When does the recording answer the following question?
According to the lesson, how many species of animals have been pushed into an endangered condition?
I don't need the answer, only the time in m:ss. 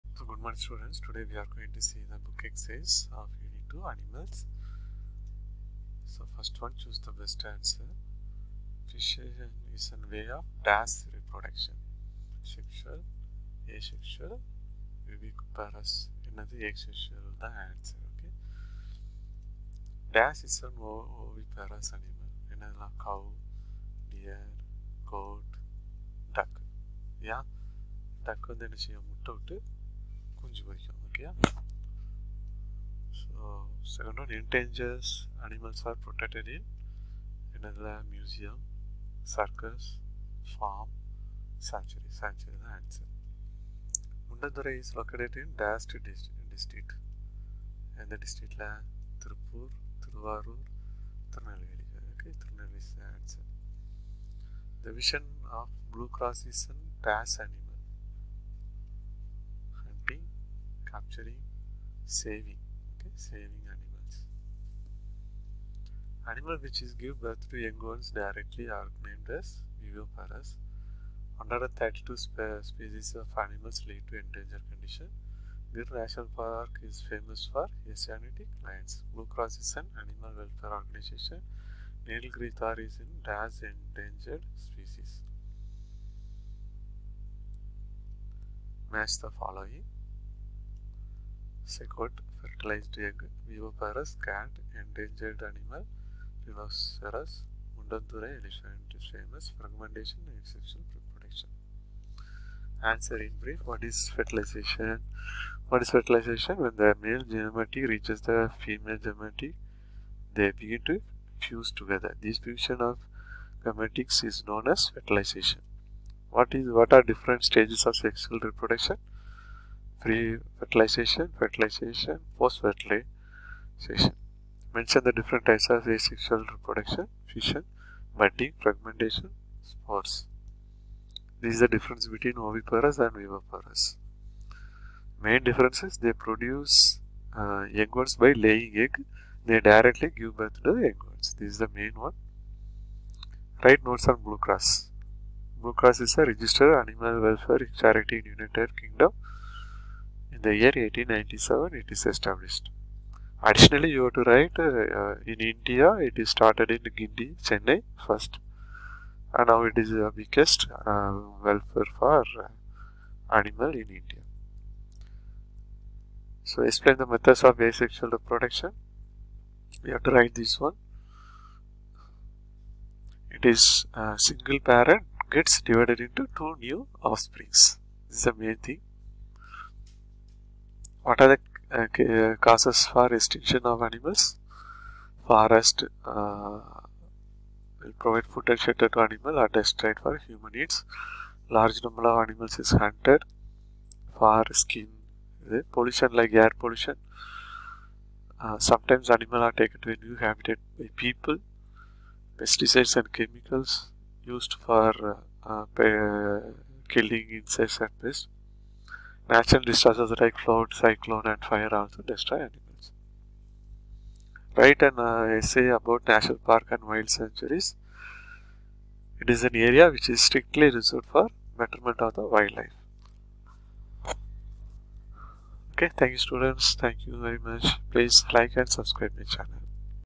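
1:11.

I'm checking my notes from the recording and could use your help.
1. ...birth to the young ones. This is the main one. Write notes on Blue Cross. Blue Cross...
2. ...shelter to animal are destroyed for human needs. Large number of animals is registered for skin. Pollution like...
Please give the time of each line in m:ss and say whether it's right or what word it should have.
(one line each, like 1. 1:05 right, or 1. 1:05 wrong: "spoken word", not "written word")
1. 2:20 right
2. 3:08 wrong: "hunted", not "registered".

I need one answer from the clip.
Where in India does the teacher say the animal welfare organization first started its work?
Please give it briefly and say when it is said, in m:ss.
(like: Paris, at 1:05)
Guindy, Chennai, at 2:36.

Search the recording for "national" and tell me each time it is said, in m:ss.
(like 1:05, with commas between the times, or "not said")
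1:15, 3:36.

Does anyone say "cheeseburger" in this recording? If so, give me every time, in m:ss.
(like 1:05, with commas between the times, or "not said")
not said.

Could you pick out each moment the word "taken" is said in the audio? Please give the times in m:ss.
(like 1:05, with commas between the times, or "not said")
3:19.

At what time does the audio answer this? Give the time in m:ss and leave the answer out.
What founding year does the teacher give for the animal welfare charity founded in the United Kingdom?
2:30.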